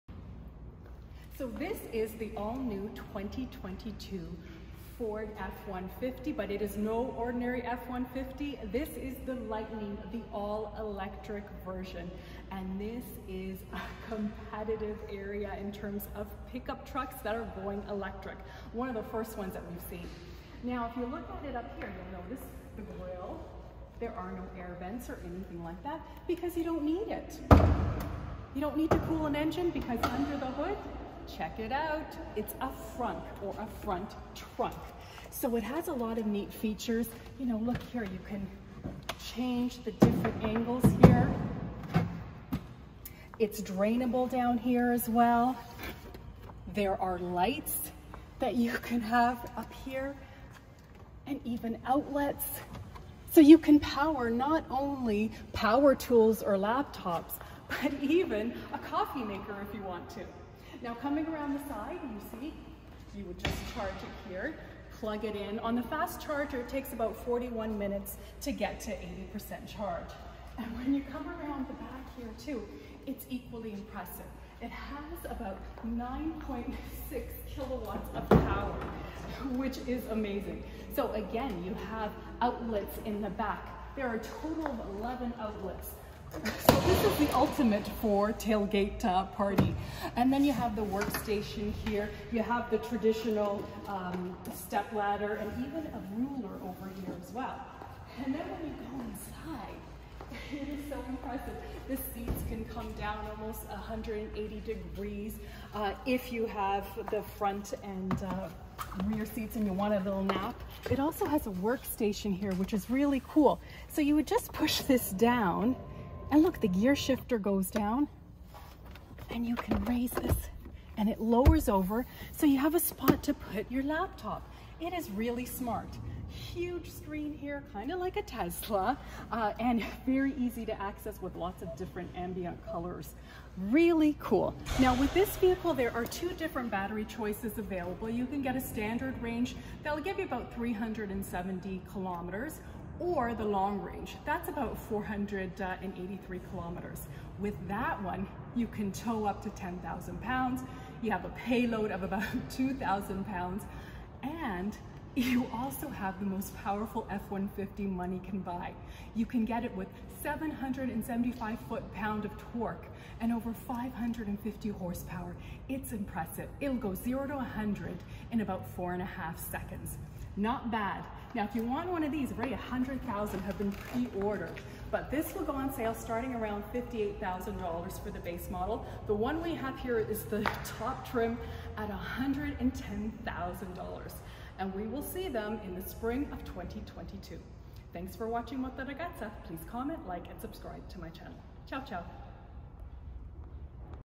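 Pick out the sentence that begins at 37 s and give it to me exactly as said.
You know, look here, you can change the different angles here.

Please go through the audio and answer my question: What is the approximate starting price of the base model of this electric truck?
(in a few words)
$58,000.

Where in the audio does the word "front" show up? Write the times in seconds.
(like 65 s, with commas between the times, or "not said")
33 s, 107 s.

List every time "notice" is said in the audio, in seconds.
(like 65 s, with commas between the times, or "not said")
22 s.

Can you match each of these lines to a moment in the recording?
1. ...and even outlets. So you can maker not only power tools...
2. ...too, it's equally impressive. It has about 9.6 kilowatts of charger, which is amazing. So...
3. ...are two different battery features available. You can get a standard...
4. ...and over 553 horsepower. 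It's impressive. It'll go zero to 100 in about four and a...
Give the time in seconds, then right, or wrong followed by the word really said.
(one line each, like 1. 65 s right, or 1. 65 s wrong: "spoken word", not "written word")
1. 51 s wrong: "power", not "maker"
2. 72 s wrong: "power", not "charger"
3. 135 s wrong: "choices", not "features"
4. 163 s wrong: "550", not "553".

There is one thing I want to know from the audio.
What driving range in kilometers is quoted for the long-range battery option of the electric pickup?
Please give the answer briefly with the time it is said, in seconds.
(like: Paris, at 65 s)
483 kilometers, at 144 s.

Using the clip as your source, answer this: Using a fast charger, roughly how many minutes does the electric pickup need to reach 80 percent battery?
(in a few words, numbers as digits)
41 minutes.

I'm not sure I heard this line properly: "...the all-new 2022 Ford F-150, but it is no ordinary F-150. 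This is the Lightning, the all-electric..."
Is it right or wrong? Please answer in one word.
right.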